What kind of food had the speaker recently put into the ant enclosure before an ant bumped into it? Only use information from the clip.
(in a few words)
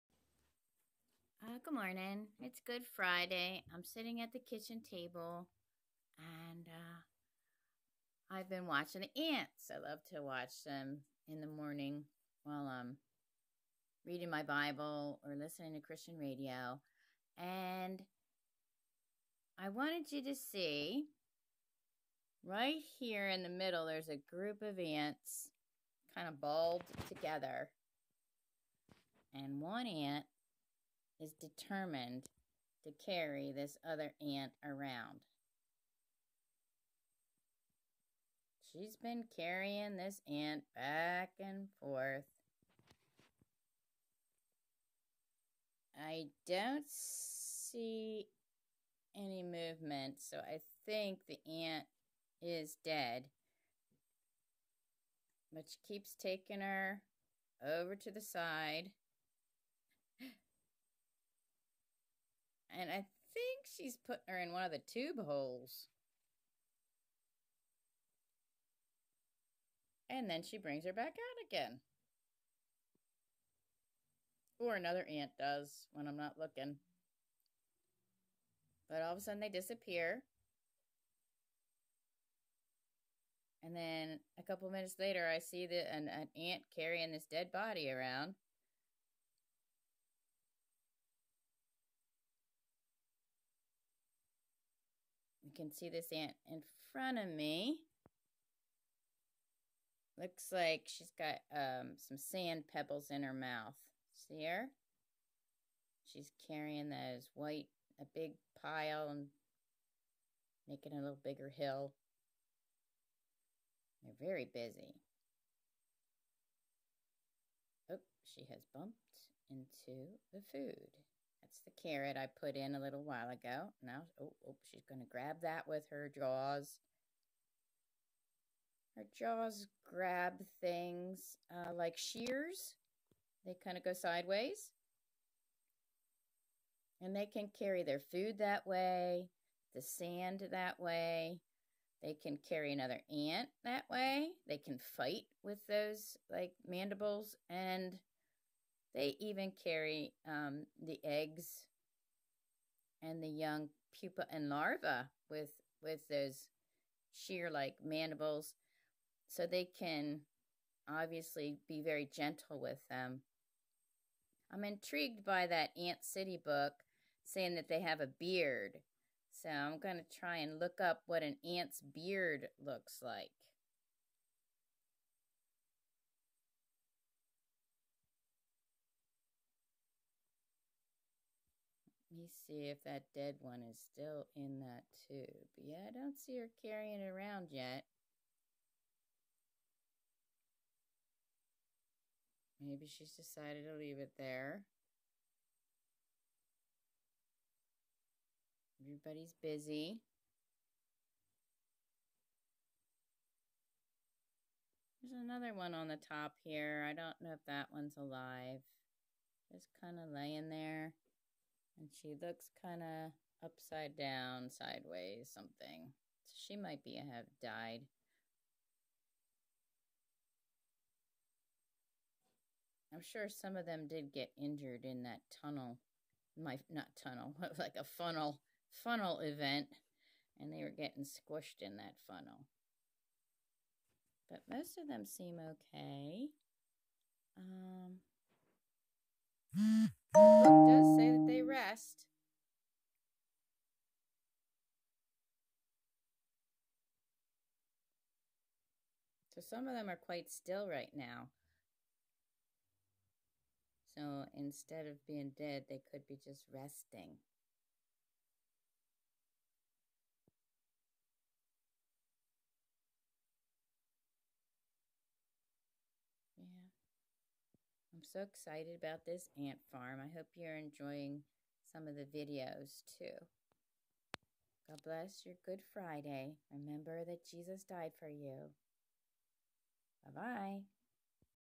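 carrot.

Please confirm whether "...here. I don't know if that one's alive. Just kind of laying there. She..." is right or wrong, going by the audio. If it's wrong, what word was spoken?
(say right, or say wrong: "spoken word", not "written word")
right.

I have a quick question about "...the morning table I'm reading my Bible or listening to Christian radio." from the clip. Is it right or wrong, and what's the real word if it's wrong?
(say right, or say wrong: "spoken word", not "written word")
wrong: "while", not "table".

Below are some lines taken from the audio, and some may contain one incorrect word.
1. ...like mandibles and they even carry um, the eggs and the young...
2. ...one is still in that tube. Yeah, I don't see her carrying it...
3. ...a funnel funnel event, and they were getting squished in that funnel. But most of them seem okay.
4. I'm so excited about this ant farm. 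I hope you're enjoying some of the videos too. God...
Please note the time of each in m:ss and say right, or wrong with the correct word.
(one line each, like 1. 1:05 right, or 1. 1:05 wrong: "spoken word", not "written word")
1. 2:26 right
2. 3:03 right
3. 3:47 right
4. 4:27 right.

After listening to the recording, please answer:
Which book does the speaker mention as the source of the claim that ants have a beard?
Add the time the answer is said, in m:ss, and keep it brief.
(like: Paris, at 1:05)
Ant City, at 2:45.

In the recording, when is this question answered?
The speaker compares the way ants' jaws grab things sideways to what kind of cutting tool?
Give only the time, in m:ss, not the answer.
2:11.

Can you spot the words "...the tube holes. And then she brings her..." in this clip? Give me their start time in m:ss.
1:04.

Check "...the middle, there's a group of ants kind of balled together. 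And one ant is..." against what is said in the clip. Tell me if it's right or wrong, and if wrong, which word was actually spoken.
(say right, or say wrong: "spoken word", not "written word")
right.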